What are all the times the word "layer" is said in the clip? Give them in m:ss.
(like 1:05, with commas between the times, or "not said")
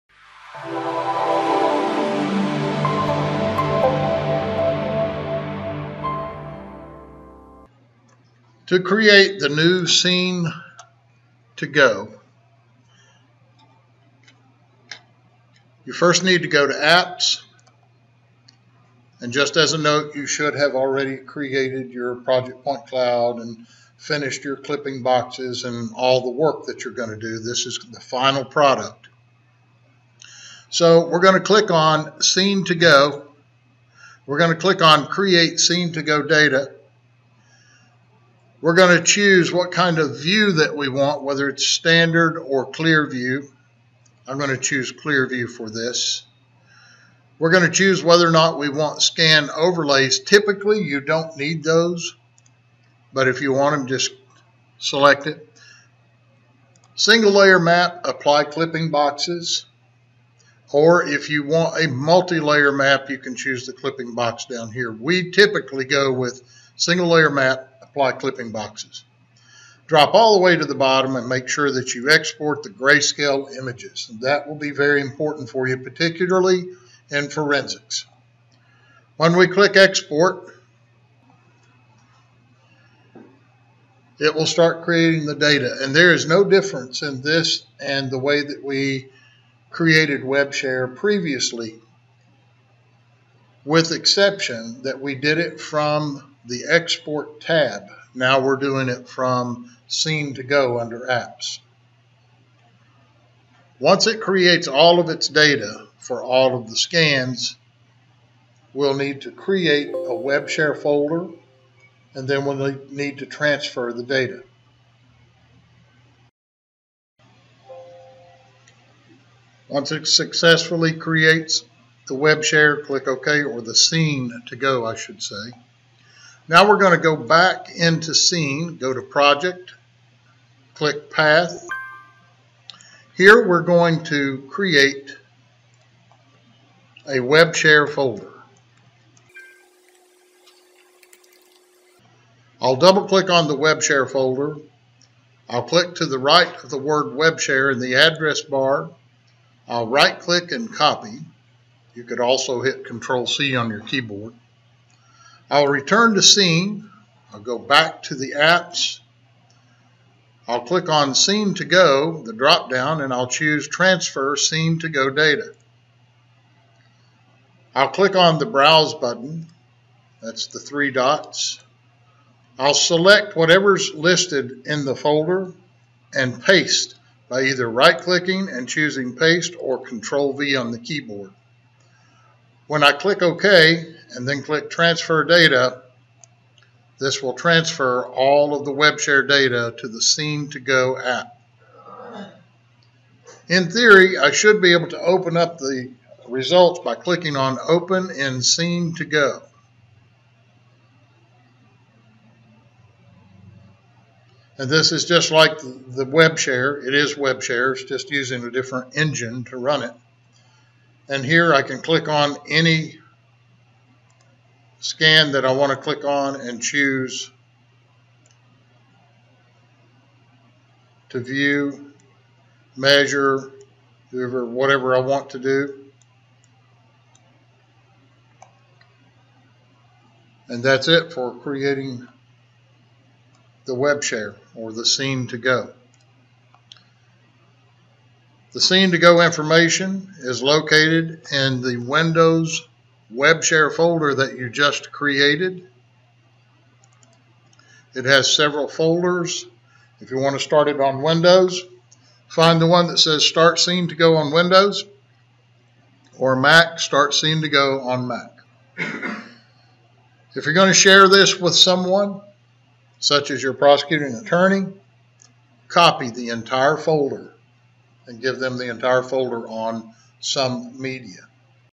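0:57, 1:01, 1:07.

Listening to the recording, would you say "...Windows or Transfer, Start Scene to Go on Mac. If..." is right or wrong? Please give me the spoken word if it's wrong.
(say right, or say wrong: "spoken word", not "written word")
wrong: "Mac", not "Transfer".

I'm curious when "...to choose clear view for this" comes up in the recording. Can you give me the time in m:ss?
0:44.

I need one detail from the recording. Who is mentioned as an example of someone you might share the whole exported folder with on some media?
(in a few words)
Prosecuting attorney.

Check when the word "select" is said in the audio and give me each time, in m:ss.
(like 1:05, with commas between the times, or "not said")
0:54, 2:52.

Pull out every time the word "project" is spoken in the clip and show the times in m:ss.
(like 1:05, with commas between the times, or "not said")
0:22, 2:09.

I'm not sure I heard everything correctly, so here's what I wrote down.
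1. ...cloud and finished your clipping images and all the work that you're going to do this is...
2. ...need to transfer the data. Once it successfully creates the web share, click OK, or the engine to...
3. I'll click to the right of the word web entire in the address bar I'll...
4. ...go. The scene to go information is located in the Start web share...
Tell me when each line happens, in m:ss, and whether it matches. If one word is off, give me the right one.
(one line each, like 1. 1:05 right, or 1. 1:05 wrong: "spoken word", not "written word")
1. 0:22 wrong: "boxes", not "images"
2. 1:52 wrong: "scene", not "engine"
3. 2:25 wrong: "share", not "entire"
4. 3:55 wrong: "Windows", not "Start".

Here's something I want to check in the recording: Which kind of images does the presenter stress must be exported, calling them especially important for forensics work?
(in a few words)
Grayscale images.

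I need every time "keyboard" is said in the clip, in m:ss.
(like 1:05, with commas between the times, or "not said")
2:33, 3:00.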